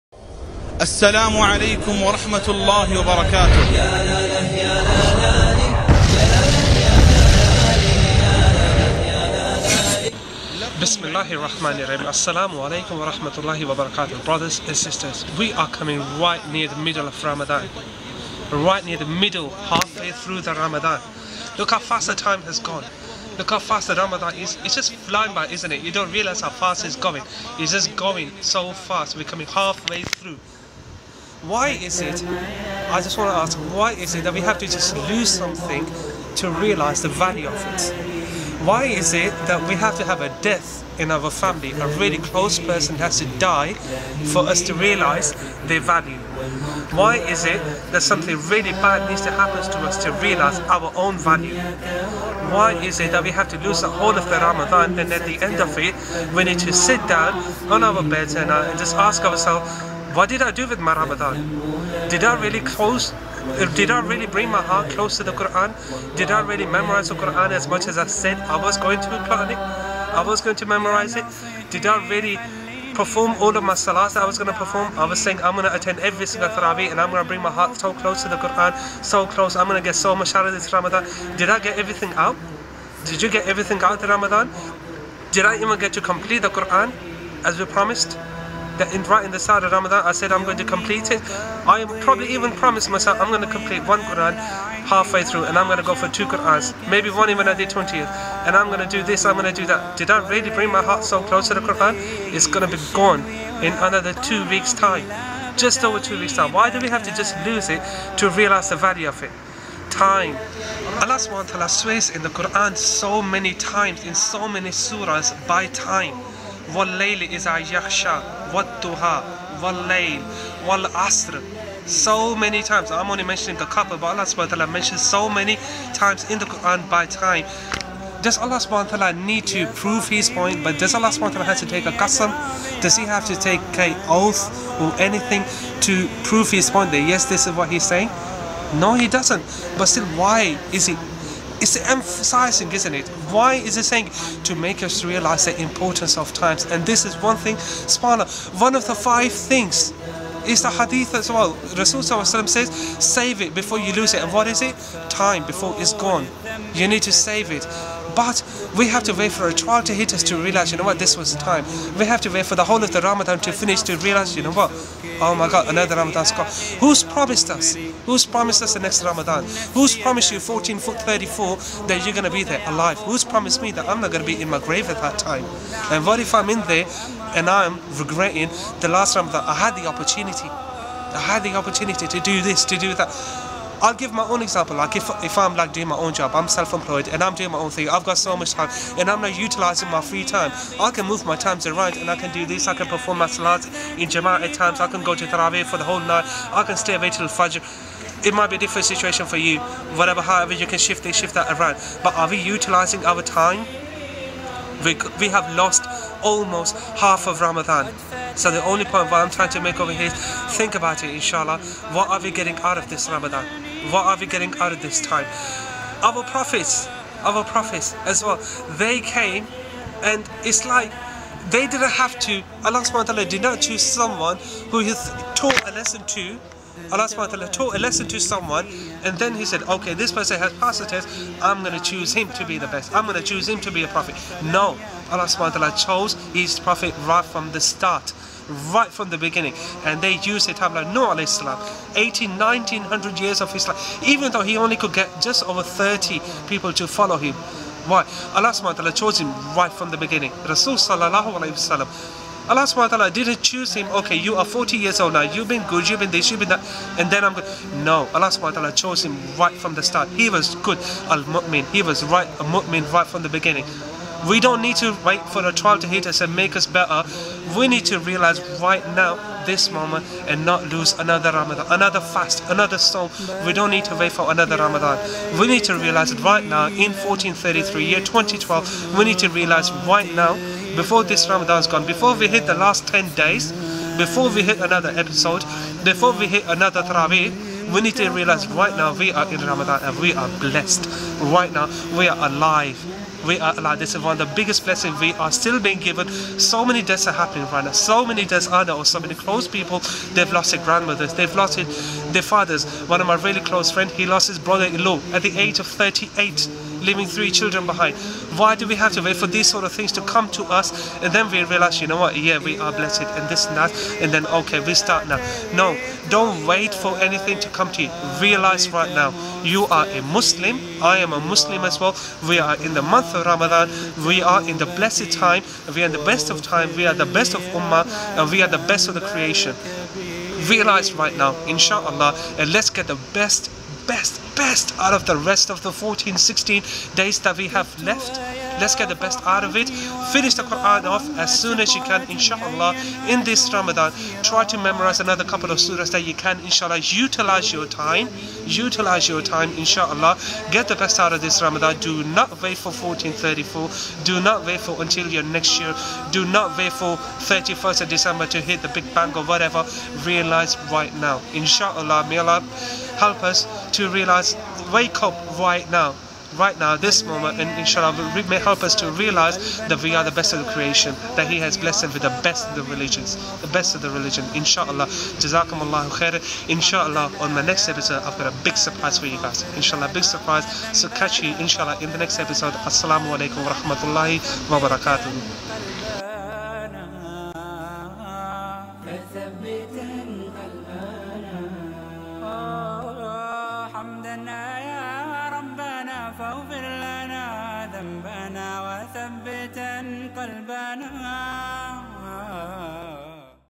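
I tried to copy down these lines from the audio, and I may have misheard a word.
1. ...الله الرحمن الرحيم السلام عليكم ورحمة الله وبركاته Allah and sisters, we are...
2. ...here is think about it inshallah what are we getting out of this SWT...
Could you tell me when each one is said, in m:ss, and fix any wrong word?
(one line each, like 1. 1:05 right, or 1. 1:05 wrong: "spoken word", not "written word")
1. 0:11 wrong: "Brothers", not "Allah"
2. 3:29 wrong: "Ramadan", not "SWT".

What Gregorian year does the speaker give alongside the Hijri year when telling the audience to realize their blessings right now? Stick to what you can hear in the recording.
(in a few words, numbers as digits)
2012.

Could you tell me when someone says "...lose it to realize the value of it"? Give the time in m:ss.
1:47.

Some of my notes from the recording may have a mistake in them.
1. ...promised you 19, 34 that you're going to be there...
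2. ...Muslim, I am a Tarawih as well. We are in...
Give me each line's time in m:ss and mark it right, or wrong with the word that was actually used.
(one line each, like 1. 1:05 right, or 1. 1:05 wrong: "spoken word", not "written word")
1. 2:49 wrong: "14", not "19"
2. 5:20 wrong: "Muslim", not "Tarawih".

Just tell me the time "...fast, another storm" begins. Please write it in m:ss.
4:31.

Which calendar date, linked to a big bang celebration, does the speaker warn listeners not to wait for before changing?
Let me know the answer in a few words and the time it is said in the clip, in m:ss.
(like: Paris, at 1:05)
31st of December, at 5:57.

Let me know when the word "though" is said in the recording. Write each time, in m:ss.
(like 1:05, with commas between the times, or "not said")
4:04.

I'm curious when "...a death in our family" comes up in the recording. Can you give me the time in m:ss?
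0:40.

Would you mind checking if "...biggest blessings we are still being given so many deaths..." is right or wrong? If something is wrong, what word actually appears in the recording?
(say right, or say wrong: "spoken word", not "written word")
right.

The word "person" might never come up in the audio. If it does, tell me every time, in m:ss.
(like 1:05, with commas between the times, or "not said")
0:42, 3:50.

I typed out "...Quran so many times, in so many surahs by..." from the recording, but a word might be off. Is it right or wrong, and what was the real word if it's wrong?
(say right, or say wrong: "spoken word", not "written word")
right.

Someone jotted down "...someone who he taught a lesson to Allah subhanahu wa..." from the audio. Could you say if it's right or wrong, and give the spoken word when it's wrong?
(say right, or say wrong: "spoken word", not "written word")
right.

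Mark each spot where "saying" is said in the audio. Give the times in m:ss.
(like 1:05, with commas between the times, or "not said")
1:15, 2:17, 2:23.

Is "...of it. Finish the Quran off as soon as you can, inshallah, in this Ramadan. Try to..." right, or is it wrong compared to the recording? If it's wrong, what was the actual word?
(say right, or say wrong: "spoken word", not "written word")
right.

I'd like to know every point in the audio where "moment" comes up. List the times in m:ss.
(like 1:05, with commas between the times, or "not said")
4:29, 6:07.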